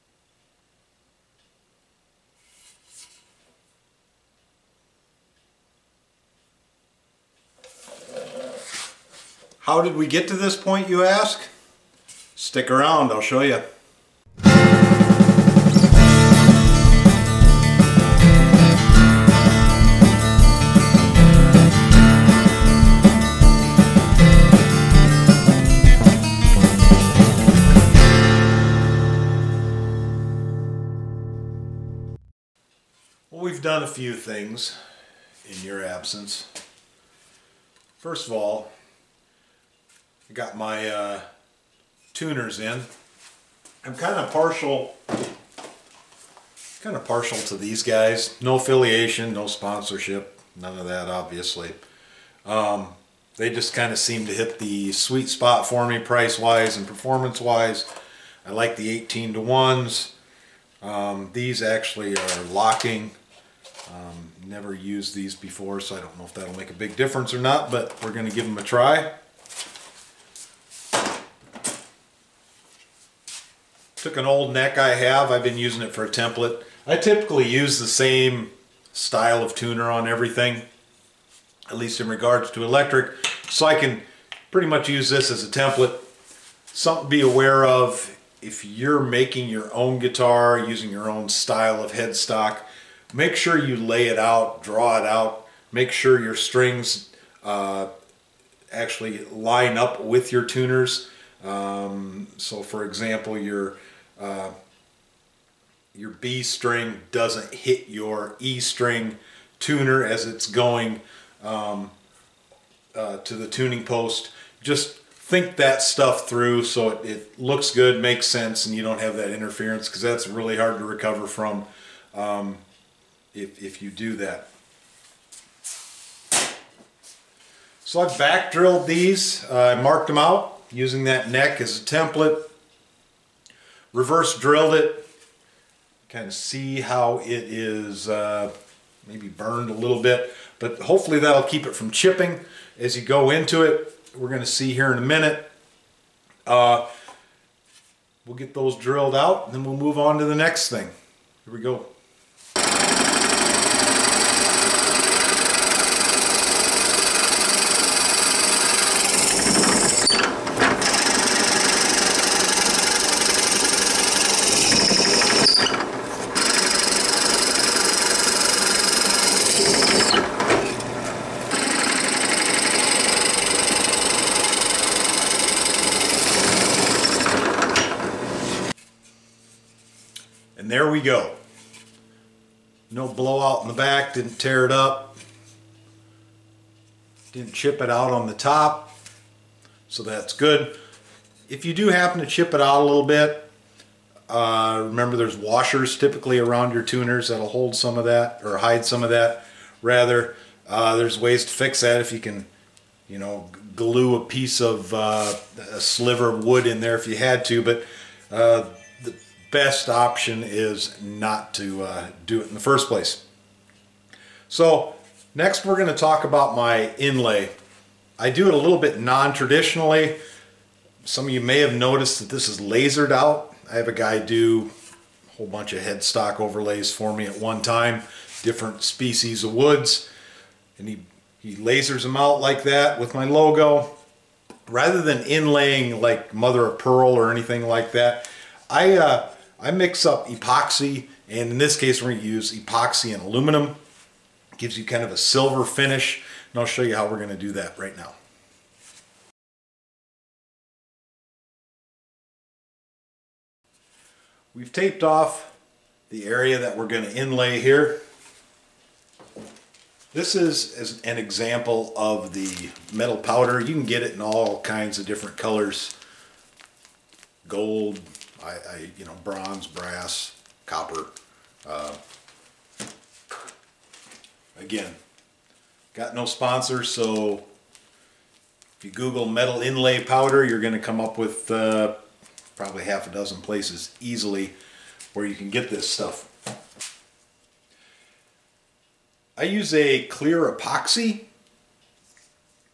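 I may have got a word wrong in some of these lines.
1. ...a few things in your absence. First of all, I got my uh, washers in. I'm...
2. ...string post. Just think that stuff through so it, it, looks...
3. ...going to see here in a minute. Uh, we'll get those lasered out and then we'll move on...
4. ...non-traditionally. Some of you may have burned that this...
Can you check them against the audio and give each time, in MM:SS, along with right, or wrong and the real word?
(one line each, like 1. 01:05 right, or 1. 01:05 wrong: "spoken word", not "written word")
1. 00:33 wrong: "tuners", not "washers"
2. 01:53 wrong: "tuning", not "string"
3. 02:24 wrong: "drilled", not "lasered"
4. 03:39 wrong: "noticed", not "burned".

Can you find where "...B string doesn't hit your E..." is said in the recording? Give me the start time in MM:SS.
01:46.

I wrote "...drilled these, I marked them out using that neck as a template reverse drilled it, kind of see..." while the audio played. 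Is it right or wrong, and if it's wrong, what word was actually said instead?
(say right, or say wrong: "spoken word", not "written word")
right.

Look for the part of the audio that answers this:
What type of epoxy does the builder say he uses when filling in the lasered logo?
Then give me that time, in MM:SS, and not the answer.
04:50.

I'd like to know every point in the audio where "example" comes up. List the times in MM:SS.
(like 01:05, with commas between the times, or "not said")
01:42, 04:21.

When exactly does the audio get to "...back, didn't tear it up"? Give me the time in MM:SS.
03:03.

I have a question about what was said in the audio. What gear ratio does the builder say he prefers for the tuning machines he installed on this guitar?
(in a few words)
18 to 1.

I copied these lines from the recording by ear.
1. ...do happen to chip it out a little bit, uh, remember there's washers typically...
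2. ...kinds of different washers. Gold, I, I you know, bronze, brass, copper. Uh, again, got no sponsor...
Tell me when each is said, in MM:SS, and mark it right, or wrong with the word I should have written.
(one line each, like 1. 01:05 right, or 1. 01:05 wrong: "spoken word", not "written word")
1. 03:11 right
2. 04:24 wrong: "colors", not "washers".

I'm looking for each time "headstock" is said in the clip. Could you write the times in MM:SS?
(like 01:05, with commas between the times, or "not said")
01:31, 03:45.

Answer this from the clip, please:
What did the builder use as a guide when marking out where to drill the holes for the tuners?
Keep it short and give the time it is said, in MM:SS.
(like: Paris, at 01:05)
an old neck, at 01:14.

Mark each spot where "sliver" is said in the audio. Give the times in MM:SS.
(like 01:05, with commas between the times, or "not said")
03:25.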